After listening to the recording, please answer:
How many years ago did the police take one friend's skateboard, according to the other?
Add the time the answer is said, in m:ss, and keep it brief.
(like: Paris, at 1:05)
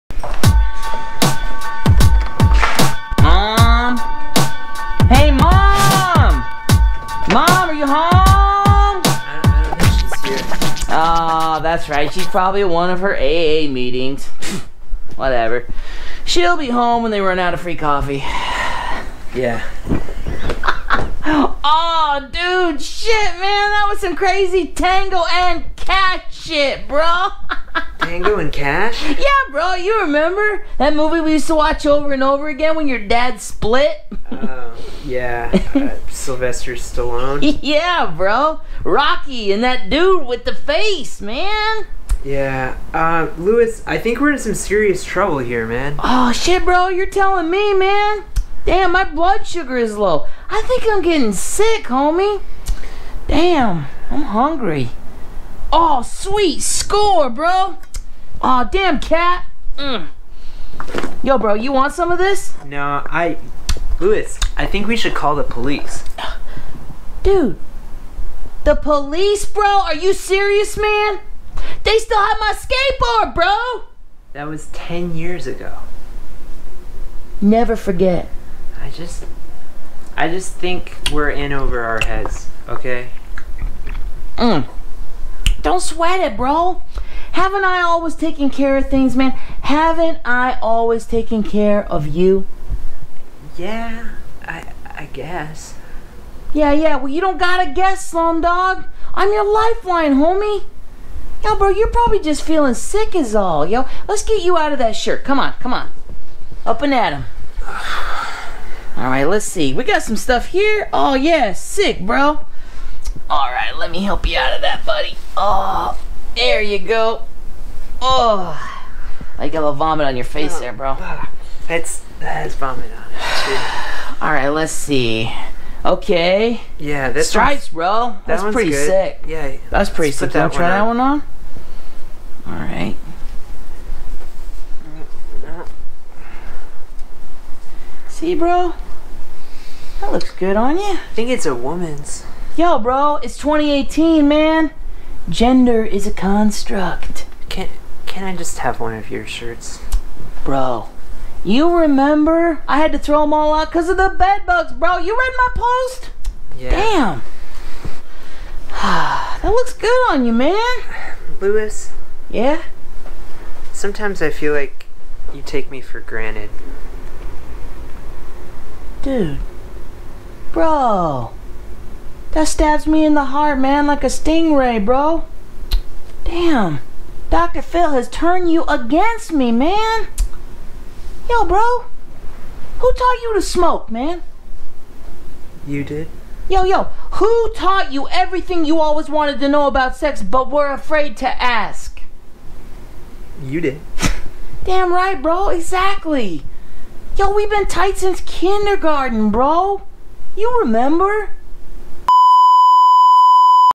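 10, at 1:14.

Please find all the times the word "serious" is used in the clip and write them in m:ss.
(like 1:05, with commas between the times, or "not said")
0:44, 1:10.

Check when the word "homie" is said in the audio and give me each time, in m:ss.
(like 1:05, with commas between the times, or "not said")
0:51, 1:40.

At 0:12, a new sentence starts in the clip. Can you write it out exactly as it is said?
She's probably at one of her AA meetings.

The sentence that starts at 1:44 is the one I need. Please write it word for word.
Let's get you out of that shirt.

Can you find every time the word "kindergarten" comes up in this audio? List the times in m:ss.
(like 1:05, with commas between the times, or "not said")
3:18.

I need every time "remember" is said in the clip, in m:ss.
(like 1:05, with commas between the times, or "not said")
0:30, 2:31, 3:20.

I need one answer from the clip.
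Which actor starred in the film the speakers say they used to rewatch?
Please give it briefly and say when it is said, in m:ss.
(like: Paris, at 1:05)
Sylvester Stallone, at 0:36.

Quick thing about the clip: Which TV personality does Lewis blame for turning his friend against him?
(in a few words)
Dr. Phil.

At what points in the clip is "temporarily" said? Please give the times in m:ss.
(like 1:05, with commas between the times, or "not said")
not said.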